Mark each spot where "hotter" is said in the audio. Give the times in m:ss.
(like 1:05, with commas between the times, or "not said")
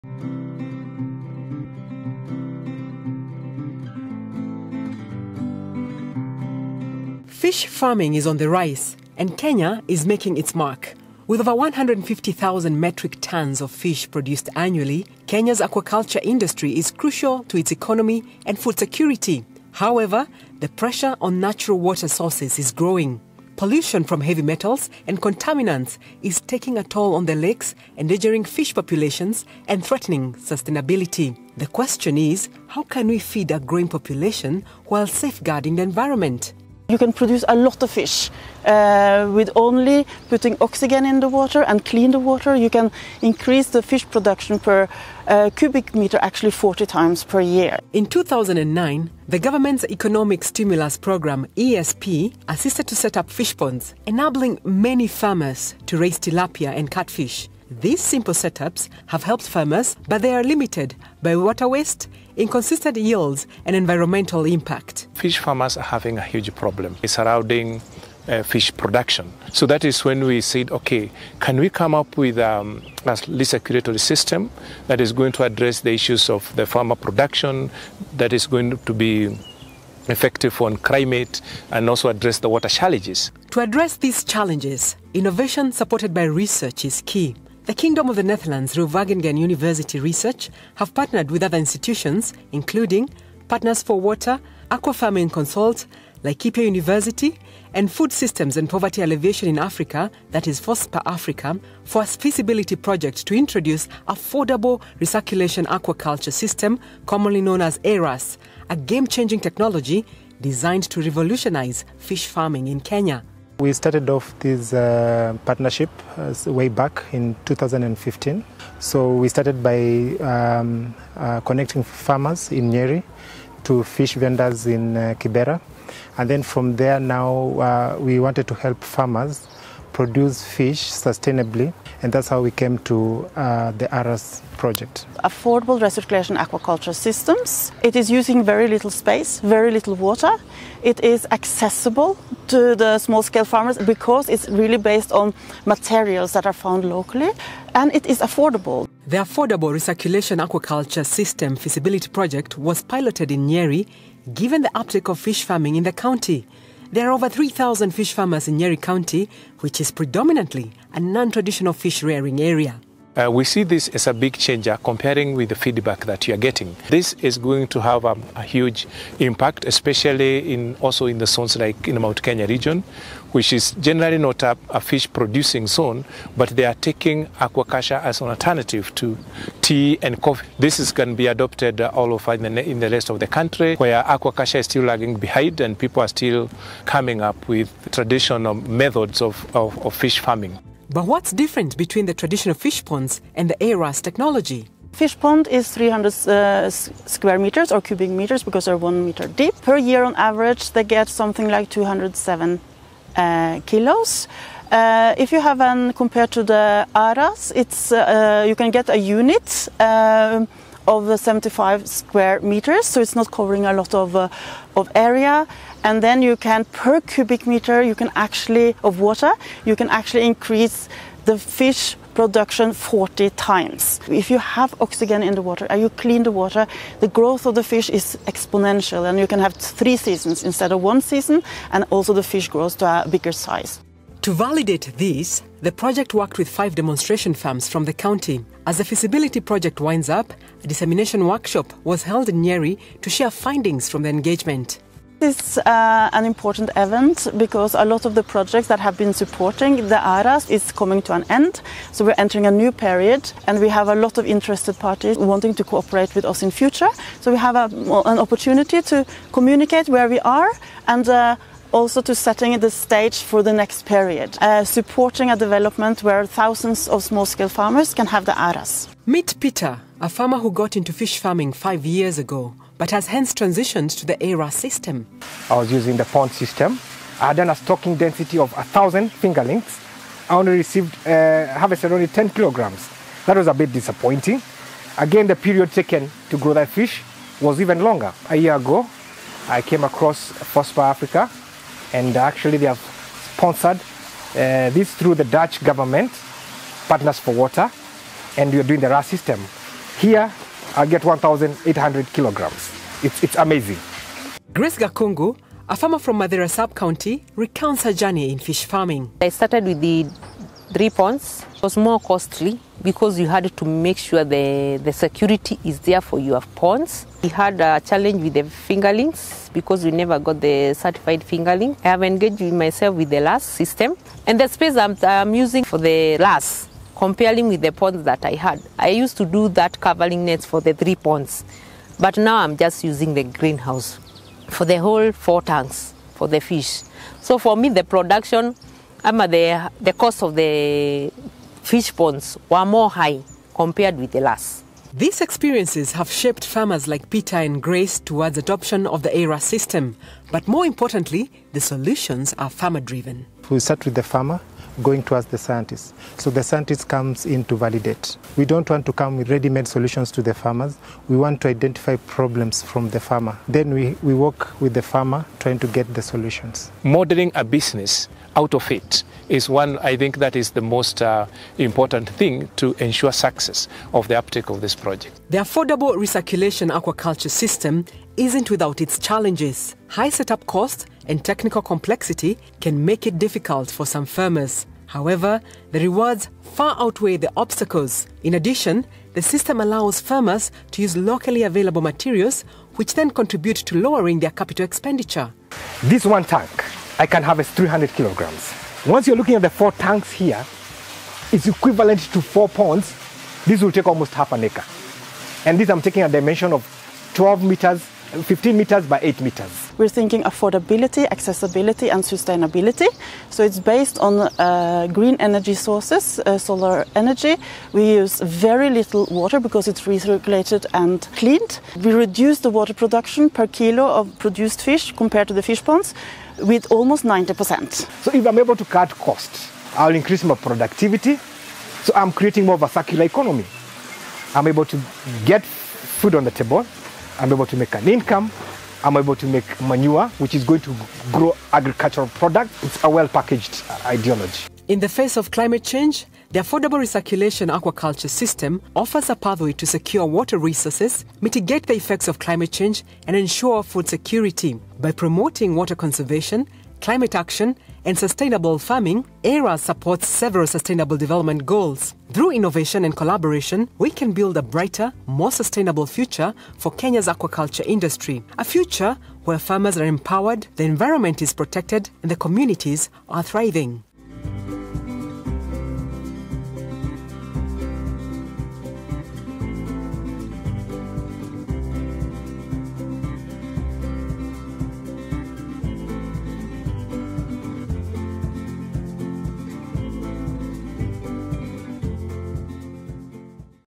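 not said.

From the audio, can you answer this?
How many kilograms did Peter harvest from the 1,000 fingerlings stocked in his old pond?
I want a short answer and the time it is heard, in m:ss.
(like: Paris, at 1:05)
10 kilograms, at 4:42.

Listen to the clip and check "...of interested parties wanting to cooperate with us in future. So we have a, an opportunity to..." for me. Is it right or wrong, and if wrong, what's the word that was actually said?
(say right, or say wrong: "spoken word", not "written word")
right.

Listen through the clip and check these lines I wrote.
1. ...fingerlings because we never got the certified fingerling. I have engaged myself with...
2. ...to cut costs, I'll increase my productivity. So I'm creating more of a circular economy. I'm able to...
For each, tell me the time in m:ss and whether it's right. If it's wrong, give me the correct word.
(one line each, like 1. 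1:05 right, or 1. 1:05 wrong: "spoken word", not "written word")
1. 5:18 right
2. 7:08 right.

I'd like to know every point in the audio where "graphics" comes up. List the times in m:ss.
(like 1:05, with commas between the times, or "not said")
not said.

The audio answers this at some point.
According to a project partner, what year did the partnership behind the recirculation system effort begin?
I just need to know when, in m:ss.
1:57.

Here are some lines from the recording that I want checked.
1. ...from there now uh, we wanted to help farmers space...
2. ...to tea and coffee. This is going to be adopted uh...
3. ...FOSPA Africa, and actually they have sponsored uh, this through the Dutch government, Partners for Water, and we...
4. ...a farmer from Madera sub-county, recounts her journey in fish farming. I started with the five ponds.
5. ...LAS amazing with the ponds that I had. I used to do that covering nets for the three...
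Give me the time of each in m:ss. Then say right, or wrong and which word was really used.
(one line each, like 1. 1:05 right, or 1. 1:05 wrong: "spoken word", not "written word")
1. 2:06 wrong: "produce", not "space"
2. 2:58 right
3. 4:50 right
4. 5:05 wrong: "three", not "five"
5. 5:26 wrong: "comparing", not "amazing".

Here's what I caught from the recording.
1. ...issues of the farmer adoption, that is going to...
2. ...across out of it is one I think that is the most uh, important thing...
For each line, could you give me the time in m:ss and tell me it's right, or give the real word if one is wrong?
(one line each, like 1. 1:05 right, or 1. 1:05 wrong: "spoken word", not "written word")
1. 1:15 wrong: "production", not "adoption"
2. 6:07 wrong: "business", not "across".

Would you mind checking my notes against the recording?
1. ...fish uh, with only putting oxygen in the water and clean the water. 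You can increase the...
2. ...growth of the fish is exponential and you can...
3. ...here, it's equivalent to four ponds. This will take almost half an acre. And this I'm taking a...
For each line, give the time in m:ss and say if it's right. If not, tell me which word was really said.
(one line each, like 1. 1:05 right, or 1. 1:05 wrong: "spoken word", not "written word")
1. 0:37 right
2. 3:47 right
3. 6:40 right.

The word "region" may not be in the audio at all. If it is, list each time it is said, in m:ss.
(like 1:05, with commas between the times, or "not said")
2:52.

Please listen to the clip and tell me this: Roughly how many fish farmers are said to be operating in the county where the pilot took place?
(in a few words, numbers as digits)
Over 3,000.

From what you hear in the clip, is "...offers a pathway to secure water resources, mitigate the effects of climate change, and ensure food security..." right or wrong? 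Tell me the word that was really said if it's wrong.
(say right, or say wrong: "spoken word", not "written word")
right.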